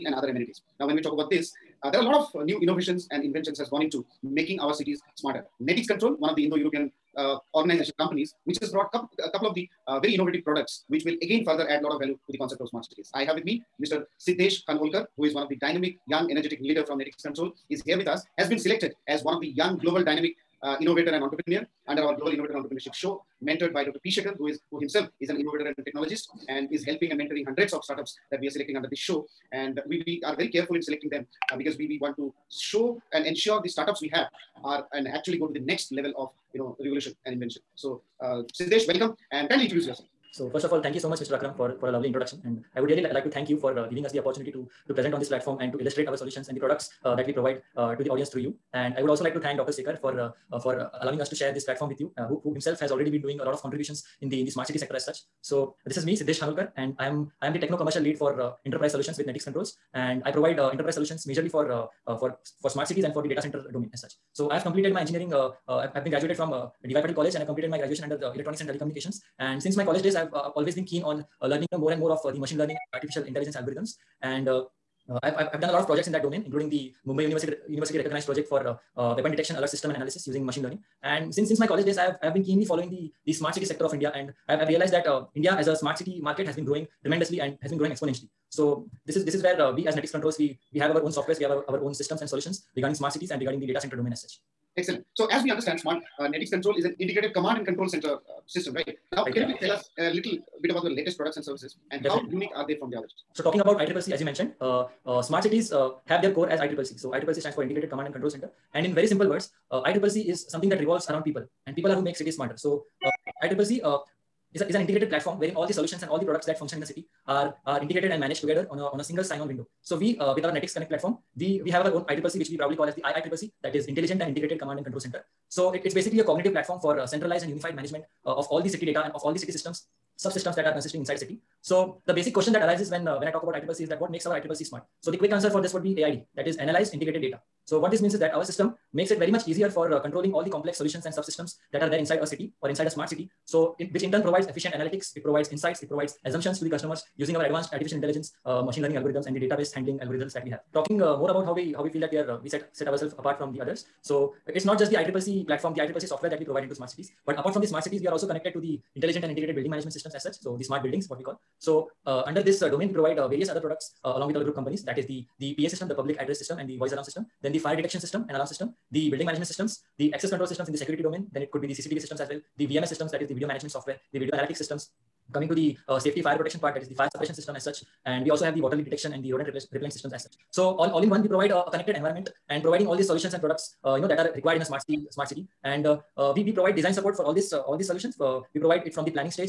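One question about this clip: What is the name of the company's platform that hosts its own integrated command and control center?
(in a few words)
Netix Connect.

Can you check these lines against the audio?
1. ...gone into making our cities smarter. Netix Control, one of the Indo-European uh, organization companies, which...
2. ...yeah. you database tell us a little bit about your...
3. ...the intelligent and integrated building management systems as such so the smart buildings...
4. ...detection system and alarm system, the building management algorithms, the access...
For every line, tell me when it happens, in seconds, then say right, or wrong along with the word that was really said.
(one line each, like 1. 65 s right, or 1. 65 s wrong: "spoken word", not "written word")
1. 3 s right
2. 99 s wrong: "please", not "database"
3. 158 s right
4. 167 s wrong: "systems", not "algorithms".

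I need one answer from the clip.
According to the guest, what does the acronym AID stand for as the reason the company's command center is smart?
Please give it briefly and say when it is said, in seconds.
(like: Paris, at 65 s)
Analyzed integrated data, at 136 s.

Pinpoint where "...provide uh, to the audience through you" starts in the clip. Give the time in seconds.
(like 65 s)
47 s.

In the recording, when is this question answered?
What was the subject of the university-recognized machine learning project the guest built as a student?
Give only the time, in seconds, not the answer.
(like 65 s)
79 s.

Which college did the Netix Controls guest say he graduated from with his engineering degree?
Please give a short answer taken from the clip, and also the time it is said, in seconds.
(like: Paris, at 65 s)
DY Patil College, at 66 s.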